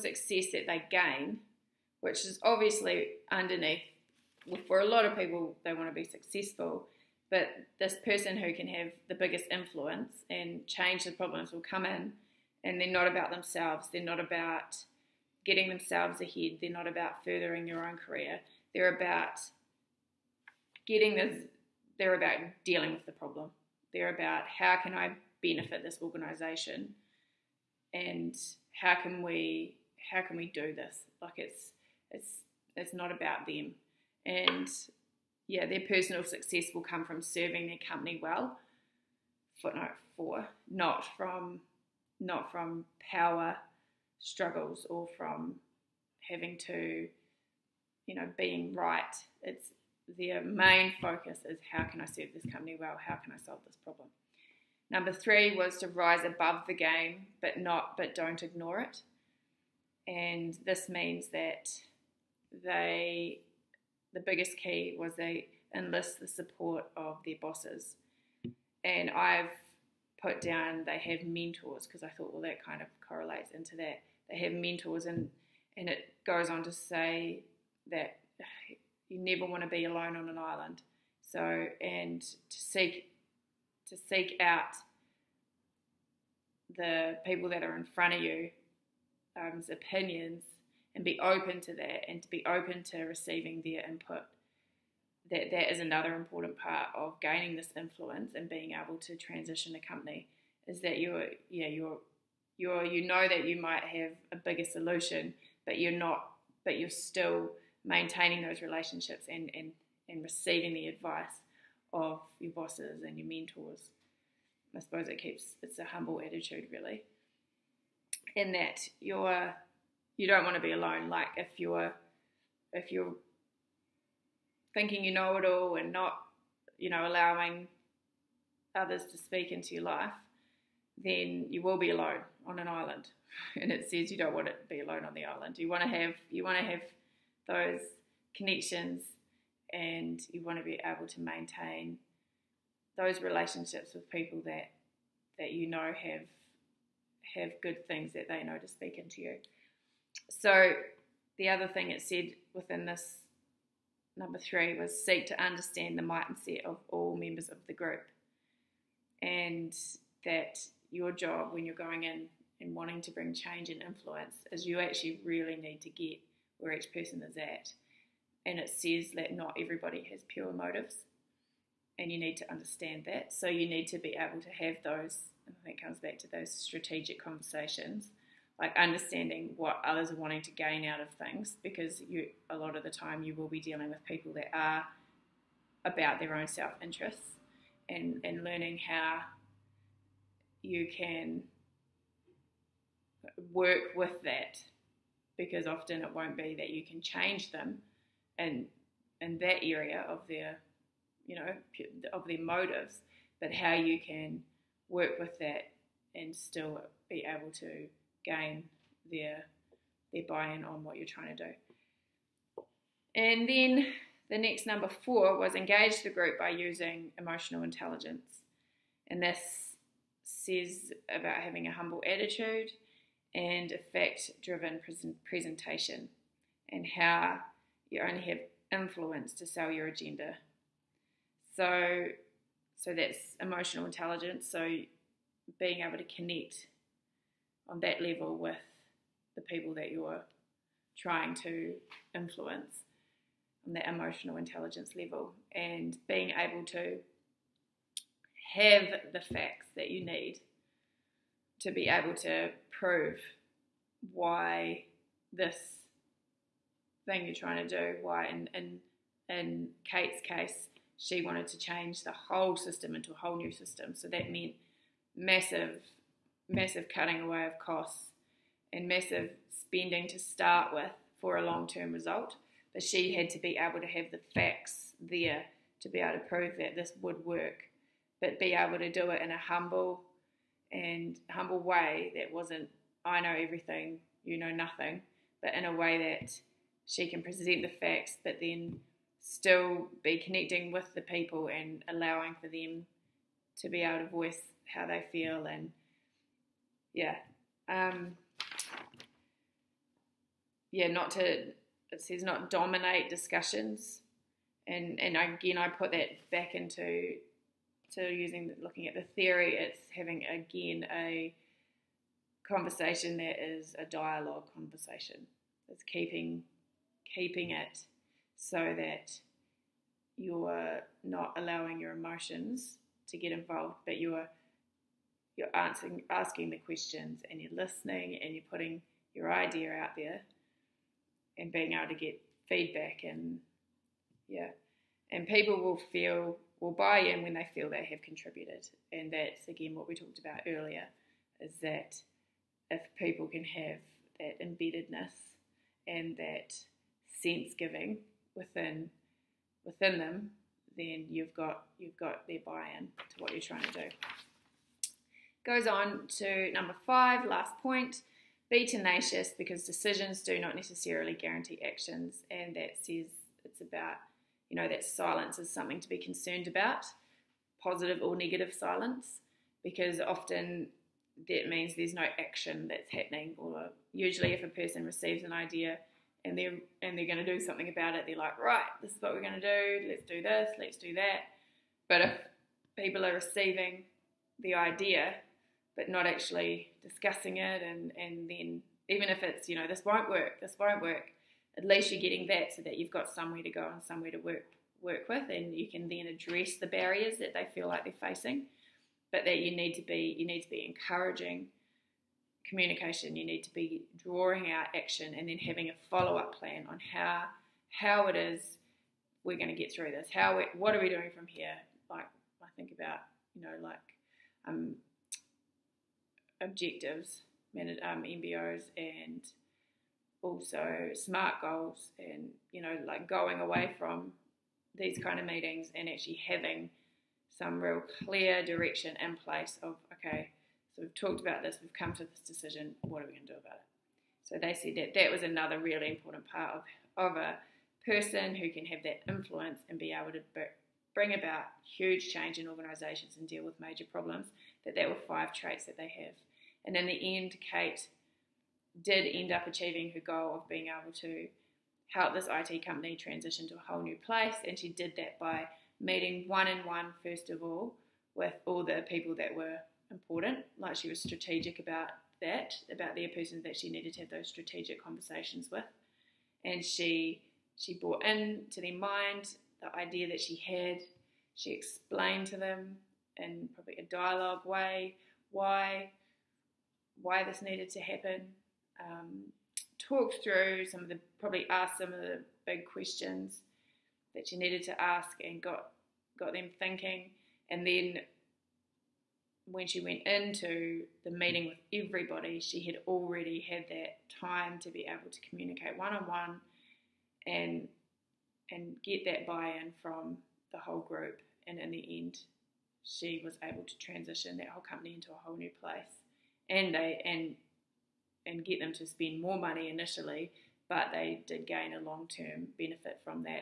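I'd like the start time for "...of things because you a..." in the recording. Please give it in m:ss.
3:00.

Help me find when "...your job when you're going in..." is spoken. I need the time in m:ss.
2:40.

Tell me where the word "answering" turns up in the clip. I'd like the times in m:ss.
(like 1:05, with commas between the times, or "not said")
5:25.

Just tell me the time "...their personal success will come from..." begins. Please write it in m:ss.
0:35.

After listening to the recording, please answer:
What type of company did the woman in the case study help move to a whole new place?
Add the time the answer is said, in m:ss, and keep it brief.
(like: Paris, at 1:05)
IT company, at 7:32.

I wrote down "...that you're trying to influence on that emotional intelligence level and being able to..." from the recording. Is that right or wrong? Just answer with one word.
right.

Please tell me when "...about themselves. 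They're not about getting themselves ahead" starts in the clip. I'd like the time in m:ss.
0:13.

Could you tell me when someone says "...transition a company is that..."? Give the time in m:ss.
1:39.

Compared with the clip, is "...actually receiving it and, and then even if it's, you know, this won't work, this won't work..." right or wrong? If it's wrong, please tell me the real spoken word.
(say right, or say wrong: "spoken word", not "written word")
wrong: "discussing", not "receiving".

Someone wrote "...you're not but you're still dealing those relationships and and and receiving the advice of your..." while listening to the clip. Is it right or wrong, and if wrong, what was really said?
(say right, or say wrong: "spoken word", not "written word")
wrong: "maintaining", not "dealing".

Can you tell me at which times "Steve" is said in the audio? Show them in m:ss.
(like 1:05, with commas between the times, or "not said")
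not said.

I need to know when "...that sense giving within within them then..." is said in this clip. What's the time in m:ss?
5:46.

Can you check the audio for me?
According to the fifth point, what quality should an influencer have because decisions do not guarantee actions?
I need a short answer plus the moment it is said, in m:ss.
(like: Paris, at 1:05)
tenacious, at 5:58.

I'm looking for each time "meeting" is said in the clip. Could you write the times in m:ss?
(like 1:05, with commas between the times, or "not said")
7:05, 7:35, 8:11.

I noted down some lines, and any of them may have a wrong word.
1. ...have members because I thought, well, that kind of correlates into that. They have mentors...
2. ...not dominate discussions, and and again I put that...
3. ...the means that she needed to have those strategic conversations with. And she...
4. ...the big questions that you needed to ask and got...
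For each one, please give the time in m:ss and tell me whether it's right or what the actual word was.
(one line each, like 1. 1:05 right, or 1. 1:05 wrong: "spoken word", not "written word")
1. 1:10 wrong: "mentors", not "members"
2. 5:02 right
3. 7:42 wrong: "persons", not "means"
4. 8:01 right.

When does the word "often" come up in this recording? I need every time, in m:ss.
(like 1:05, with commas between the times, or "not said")
3:15, 6:09.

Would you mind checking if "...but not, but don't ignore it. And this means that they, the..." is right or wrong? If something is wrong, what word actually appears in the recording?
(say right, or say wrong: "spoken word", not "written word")
right.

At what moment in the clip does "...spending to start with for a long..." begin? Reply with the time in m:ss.
4:29.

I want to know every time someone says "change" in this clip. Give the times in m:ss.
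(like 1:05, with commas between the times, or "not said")
0:10, 2:43, 3:17, 4:21, 7:22.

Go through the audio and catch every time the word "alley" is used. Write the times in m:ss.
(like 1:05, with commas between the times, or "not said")
not said.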